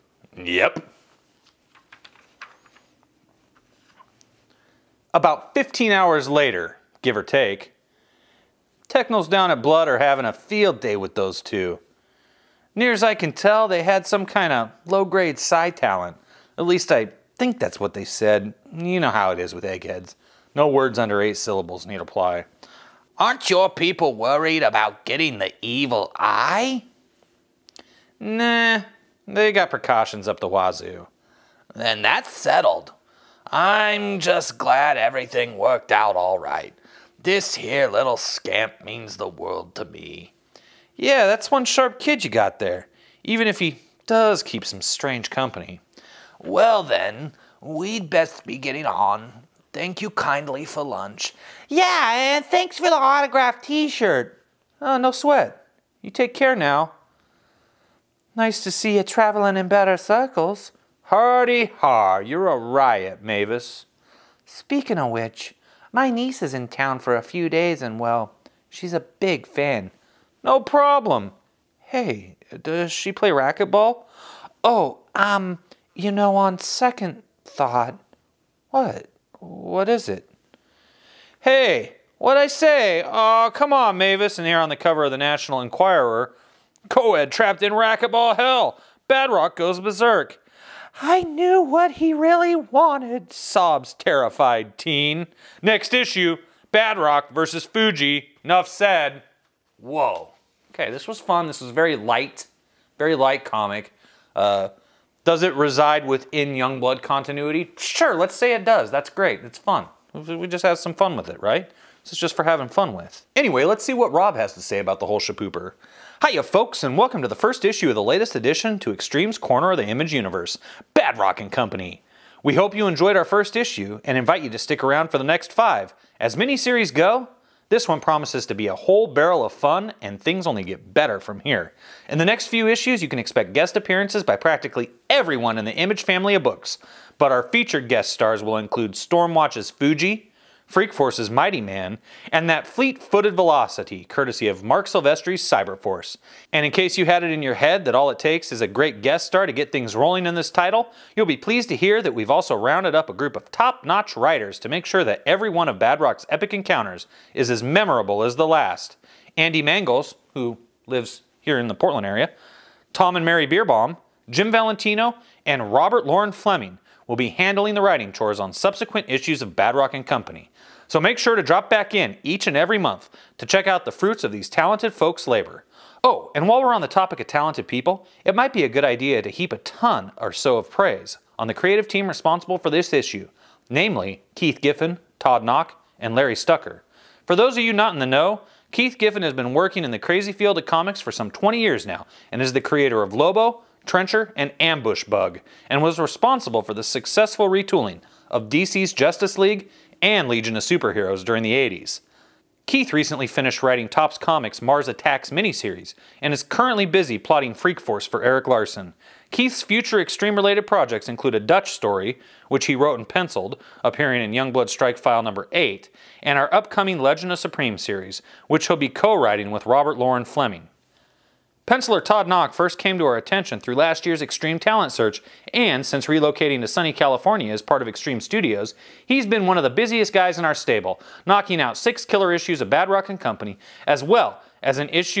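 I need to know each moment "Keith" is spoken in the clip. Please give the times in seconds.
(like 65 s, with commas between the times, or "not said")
184 s, 188 s, 202 s, 209 s.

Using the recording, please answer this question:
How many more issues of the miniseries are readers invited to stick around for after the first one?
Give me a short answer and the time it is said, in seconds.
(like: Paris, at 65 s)
5, at 125 s.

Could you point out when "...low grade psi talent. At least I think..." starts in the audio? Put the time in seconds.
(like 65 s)
14 s.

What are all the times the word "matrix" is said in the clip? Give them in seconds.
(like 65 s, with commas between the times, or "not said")
not said.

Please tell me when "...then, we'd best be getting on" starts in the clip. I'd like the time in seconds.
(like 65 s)
46 s.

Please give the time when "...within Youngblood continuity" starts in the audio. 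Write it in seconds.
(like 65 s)
106 s.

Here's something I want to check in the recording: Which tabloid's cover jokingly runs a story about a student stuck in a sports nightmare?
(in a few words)
National Enquirer.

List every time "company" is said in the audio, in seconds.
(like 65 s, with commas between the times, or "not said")
45 s, 121 s, 170 s, 233 s.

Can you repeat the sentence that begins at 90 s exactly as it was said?
I knew what he really wanted, sobs terrified teen.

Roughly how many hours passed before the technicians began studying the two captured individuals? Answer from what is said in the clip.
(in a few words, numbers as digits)
15.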